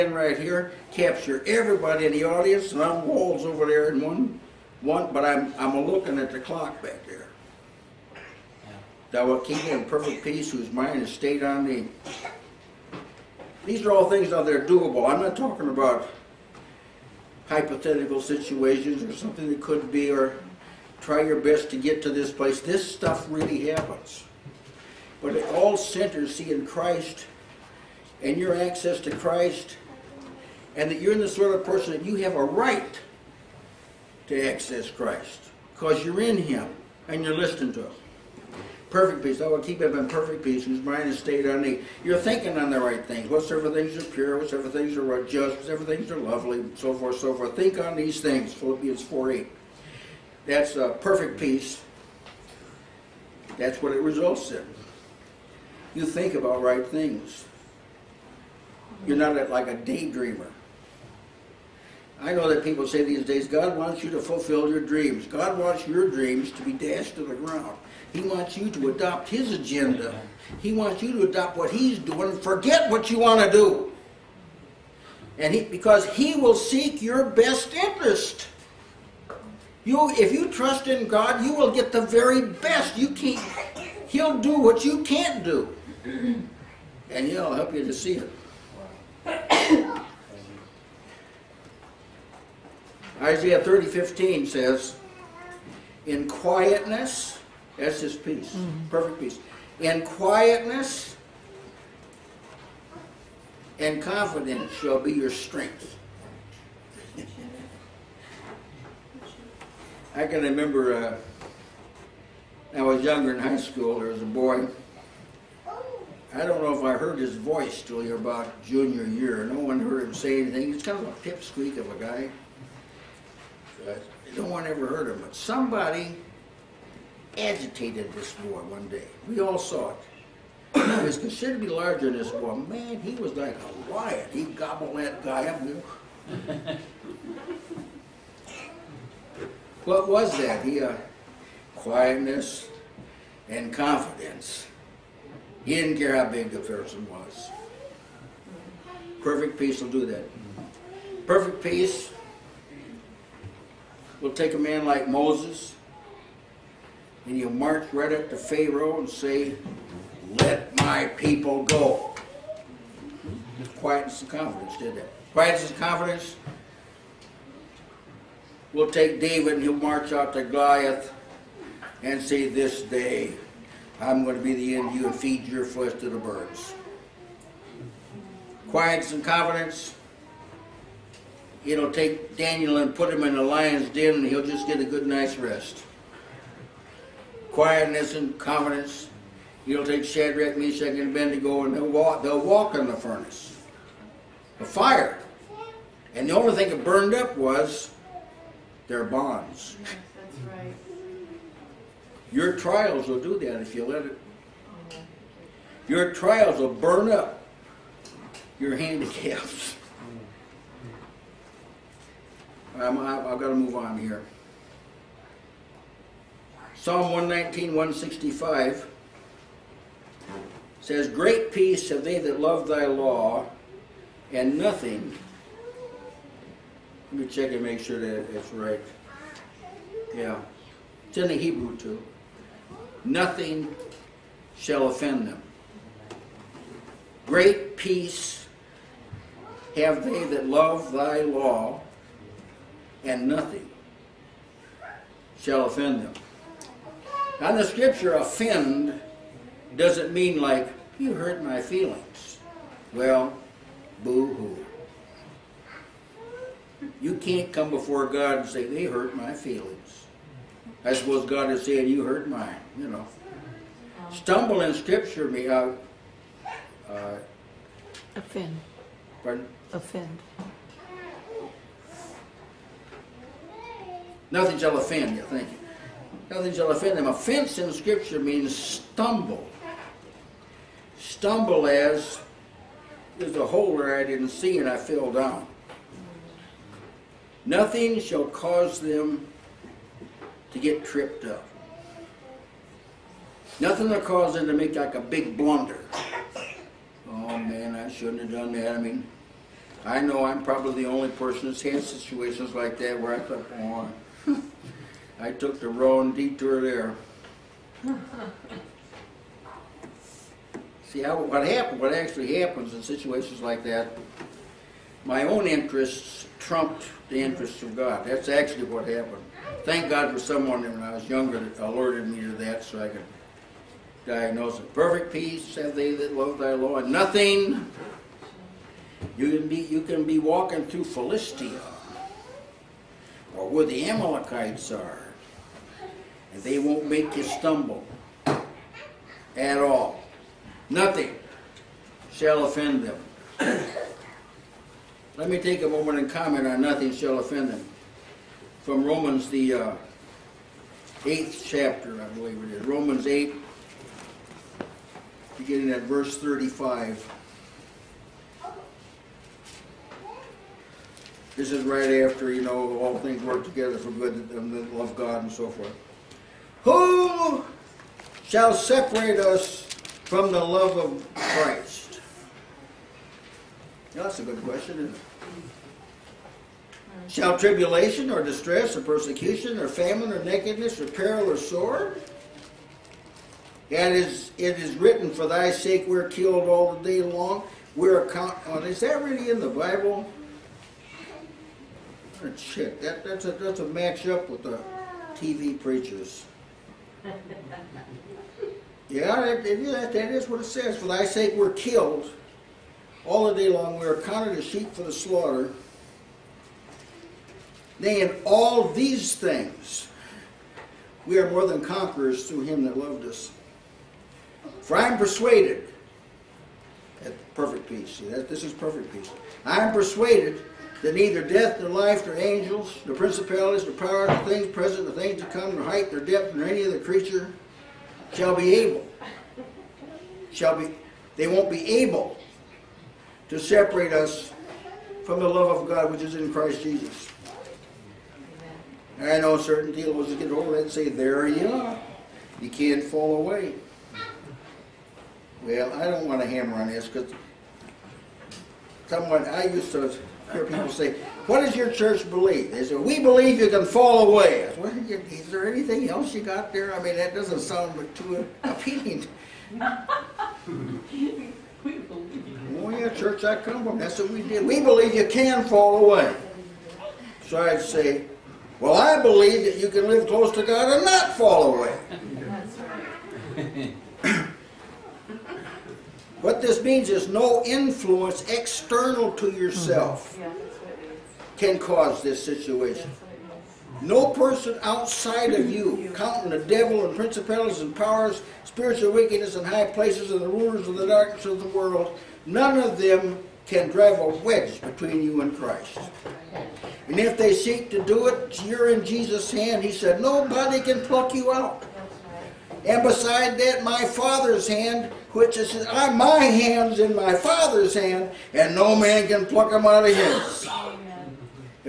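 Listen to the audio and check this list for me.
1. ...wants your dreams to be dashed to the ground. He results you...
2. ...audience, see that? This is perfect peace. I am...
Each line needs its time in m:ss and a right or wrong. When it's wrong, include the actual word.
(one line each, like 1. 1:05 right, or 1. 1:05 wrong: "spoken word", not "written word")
1. 1:05 wrong: "wants", not "results"
2. 6:57 wrong: "peace", not "audience".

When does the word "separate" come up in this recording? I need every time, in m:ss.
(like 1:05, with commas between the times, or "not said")
6:08, 7:13.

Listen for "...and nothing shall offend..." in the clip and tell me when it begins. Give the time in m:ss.
4:03.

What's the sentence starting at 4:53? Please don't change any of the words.
Nothing will cause them to make like a big blunder.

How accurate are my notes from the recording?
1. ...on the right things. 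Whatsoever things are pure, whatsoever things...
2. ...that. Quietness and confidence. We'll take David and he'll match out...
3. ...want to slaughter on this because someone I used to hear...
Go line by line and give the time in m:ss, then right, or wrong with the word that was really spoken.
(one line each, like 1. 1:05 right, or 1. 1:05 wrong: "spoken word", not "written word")
1. 0:42 right
2. 2:44 wrong: "march", not "match"
3. 7:26 wrong: "hammer", not "slaughter".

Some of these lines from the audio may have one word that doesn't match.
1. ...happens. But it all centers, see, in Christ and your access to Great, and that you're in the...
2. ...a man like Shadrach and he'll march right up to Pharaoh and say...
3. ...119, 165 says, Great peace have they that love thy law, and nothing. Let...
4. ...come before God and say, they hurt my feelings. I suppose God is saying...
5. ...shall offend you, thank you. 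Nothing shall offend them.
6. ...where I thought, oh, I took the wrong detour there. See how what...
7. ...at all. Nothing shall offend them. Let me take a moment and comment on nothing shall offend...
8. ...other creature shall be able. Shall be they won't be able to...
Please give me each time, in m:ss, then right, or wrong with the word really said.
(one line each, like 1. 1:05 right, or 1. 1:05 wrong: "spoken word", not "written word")
1. 0:23 wrong: "Christ", not "Great"
2. 2:34 wrong: "Moses", not "Shadrach"
3. 3:37 right
4. 4:17 right
5. 4:34 right
6. 5:02 right
7. 5:39 right
8. 7:06 right.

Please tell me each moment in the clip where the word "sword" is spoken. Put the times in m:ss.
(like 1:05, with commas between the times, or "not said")
6:21.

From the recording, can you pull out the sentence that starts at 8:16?
And if they seek to do it, you're in Jesus' hand.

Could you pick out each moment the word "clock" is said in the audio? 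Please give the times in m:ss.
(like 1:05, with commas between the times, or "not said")
0:06.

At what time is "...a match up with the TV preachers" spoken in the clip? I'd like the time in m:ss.
6:33.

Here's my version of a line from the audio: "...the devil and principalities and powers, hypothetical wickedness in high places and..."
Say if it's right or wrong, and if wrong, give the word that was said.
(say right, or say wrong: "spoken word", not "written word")
wrong: "spiritual", not "hypothetical".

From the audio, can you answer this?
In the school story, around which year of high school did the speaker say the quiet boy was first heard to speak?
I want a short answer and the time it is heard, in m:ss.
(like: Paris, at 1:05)
junior year, at 1:58.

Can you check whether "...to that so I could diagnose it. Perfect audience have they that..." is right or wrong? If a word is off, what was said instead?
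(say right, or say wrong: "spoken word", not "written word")
wrong: "peace", not "audience".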